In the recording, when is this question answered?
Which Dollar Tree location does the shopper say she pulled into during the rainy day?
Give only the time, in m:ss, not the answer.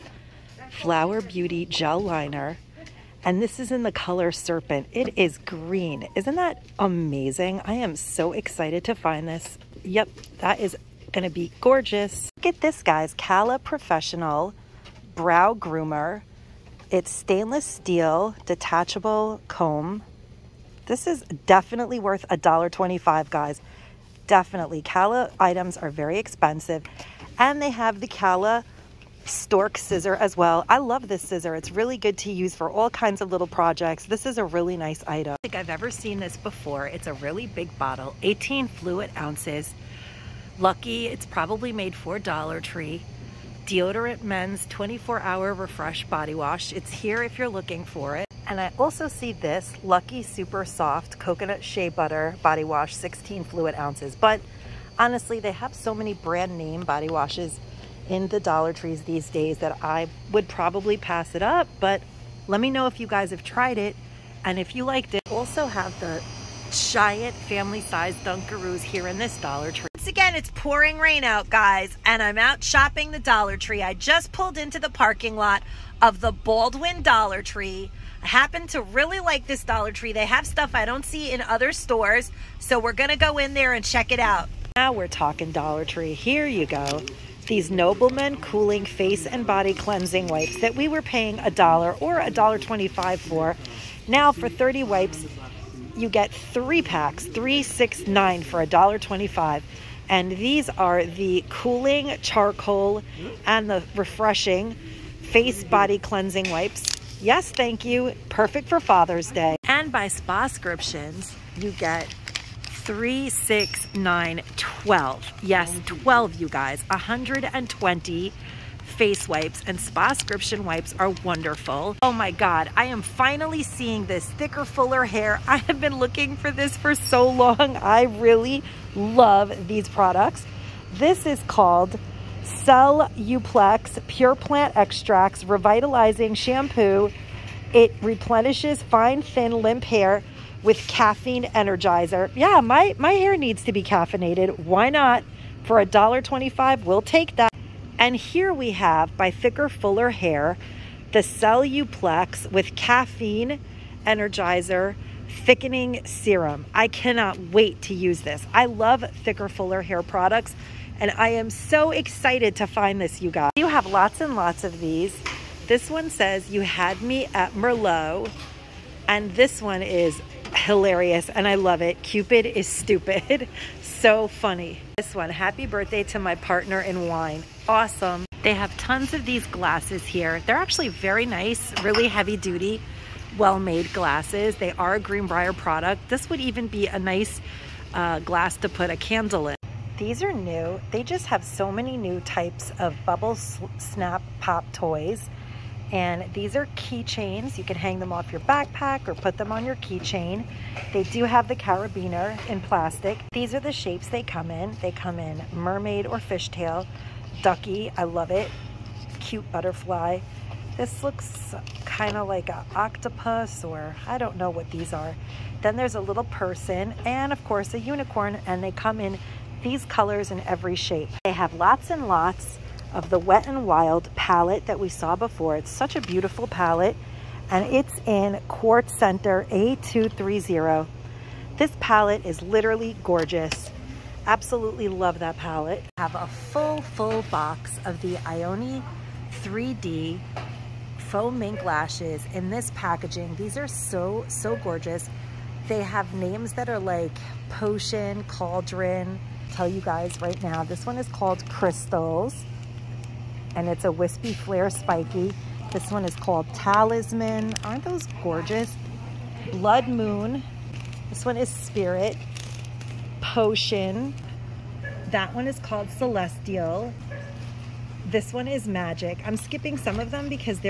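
1:16.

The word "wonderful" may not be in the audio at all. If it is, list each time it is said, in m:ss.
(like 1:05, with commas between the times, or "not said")
2:01.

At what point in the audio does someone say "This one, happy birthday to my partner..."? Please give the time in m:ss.
2:54.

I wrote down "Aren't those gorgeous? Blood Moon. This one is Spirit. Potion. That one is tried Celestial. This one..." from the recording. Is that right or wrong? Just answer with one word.
wrong.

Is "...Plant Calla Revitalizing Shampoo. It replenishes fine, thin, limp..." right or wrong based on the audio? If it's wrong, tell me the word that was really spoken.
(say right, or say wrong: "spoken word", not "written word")
wrong: "Extracts", not "Calla".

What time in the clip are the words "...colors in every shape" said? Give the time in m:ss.
3:39.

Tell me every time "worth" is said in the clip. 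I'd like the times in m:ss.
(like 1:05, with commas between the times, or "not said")
0:22.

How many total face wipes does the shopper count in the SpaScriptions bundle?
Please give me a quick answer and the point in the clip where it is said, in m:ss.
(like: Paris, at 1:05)
120, at 1:56.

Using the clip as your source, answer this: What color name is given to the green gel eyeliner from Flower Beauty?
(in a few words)
Serpent.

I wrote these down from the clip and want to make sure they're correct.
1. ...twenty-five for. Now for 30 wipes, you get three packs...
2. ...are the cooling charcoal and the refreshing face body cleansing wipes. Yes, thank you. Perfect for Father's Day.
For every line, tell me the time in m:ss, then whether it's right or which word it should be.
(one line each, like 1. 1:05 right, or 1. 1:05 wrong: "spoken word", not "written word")
1. 1:32 right
2. 1:40 right.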